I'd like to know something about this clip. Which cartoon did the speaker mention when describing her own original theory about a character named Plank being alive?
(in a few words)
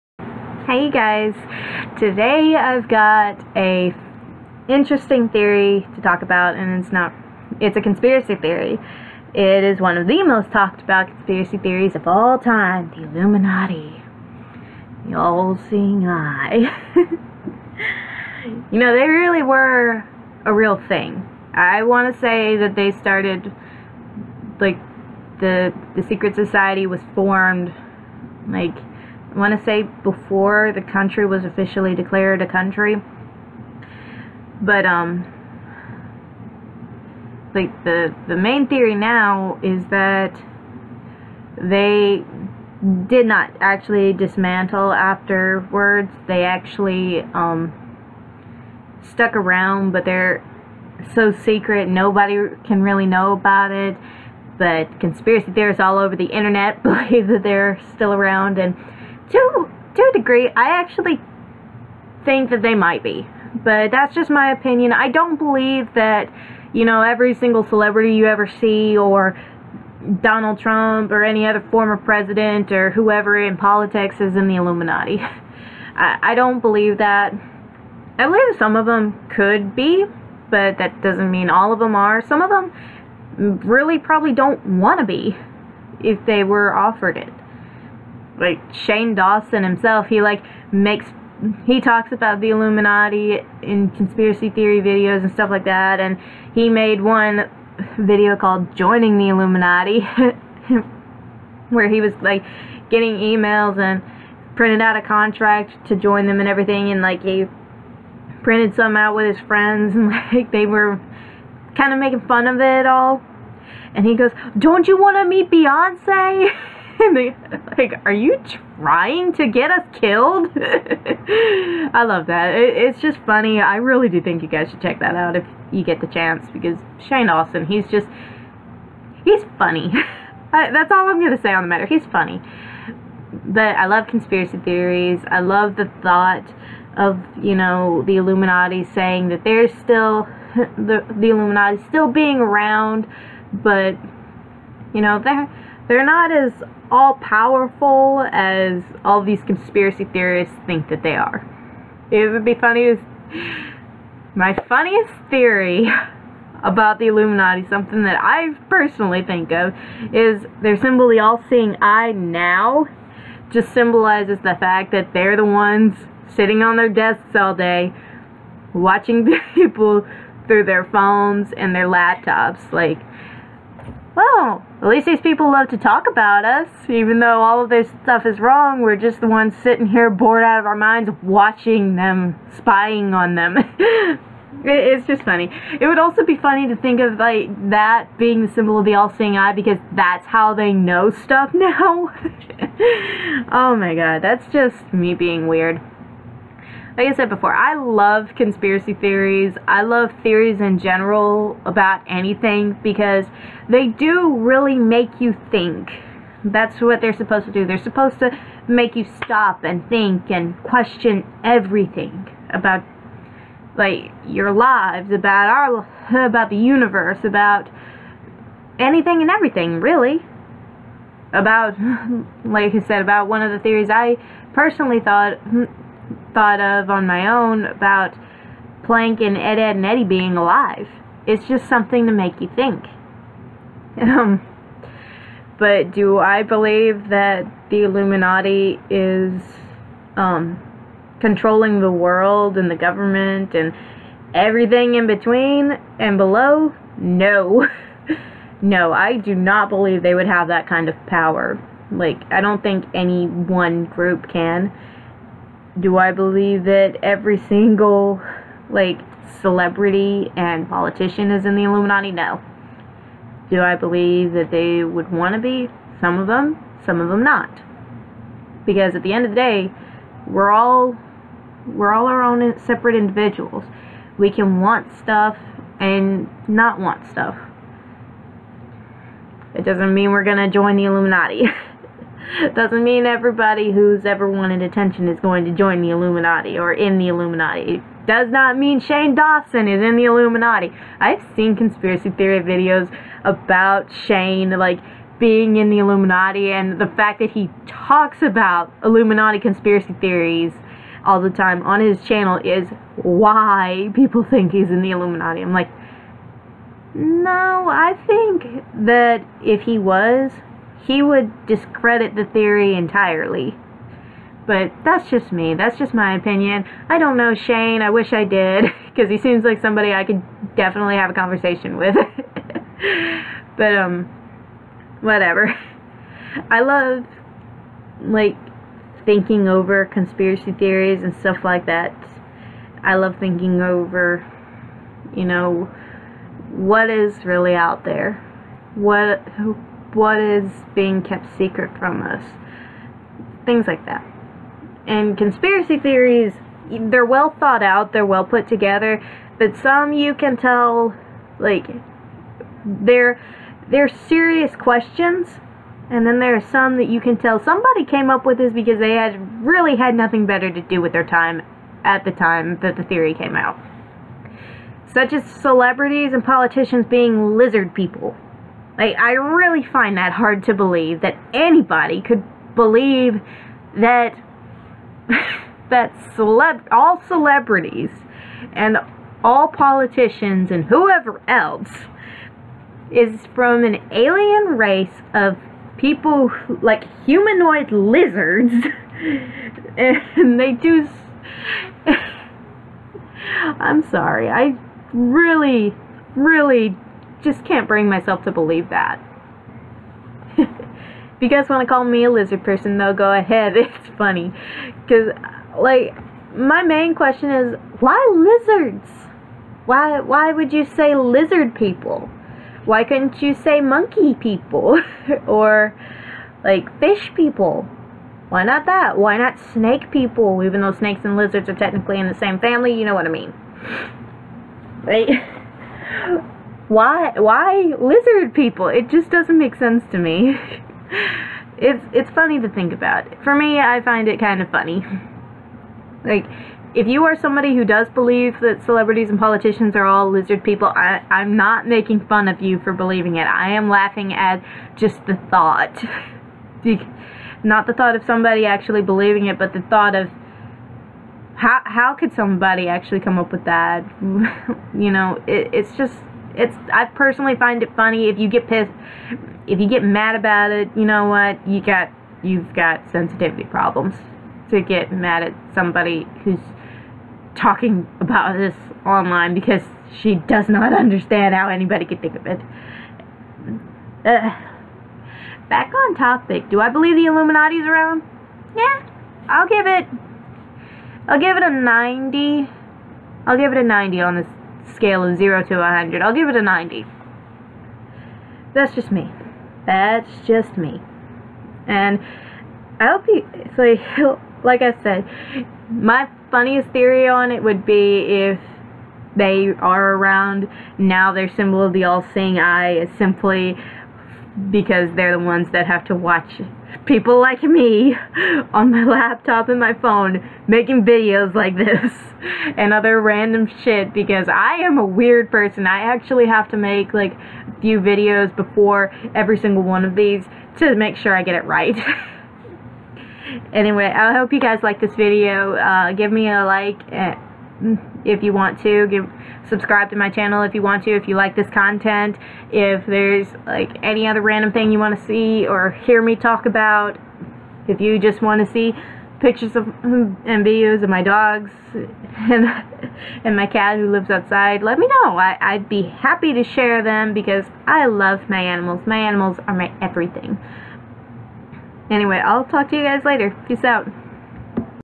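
Ed, Edd, and Eddy.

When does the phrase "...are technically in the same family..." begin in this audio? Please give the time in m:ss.
7:01.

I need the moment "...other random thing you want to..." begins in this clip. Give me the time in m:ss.
8:54.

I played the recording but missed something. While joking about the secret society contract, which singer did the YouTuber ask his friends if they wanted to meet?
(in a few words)
Beyonce.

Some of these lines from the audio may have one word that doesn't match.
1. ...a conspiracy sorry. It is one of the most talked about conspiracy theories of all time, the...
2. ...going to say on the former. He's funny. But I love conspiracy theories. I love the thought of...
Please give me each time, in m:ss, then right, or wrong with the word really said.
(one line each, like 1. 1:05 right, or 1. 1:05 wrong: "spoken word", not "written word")
1. 0:07 wrong: "theory", not "sorry"
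2. 2:11 wrong: "matter", not "former".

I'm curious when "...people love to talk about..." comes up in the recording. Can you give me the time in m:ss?
2:55.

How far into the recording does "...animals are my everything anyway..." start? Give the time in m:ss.
9:08.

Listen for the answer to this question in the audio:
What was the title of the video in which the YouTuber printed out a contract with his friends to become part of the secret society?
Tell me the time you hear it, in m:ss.
1:38.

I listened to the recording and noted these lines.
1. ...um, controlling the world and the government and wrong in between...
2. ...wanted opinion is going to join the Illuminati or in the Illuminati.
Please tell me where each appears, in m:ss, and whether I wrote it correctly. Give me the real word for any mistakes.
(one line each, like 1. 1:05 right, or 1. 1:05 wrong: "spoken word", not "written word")
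1. 4:00 wrong: "everything", not "wrong"
2. 4:44 wrong: "attention", not "opinion".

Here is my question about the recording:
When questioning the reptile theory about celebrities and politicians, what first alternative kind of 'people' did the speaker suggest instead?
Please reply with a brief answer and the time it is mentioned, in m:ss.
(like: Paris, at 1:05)
monkey people, at 6:53.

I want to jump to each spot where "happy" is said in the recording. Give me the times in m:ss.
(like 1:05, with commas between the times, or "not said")
9:05.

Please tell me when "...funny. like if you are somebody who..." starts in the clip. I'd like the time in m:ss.
7:14.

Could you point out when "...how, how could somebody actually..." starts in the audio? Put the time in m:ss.
7:31.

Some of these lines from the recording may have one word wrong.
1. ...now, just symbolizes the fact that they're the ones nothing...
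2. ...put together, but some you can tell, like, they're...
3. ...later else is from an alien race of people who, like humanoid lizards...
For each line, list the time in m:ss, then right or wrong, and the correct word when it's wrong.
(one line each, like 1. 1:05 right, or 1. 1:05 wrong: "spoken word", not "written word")
1. 2:42 wrong: "sitting", not "nothing"
2. 5:48 right
3. 6:20 wrong: "whoever", not "later".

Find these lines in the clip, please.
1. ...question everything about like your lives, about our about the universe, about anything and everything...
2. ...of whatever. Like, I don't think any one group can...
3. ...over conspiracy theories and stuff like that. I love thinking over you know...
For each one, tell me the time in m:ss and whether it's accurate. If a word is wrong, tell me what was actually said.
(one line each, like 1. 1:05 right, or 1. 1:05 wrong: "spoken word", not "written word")
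1. 3:30 right
2. 4:10 wrong: "power", not "whatever"
3. 5:29 right.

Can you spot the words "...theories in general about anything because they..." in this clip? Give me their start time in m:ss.
3:20.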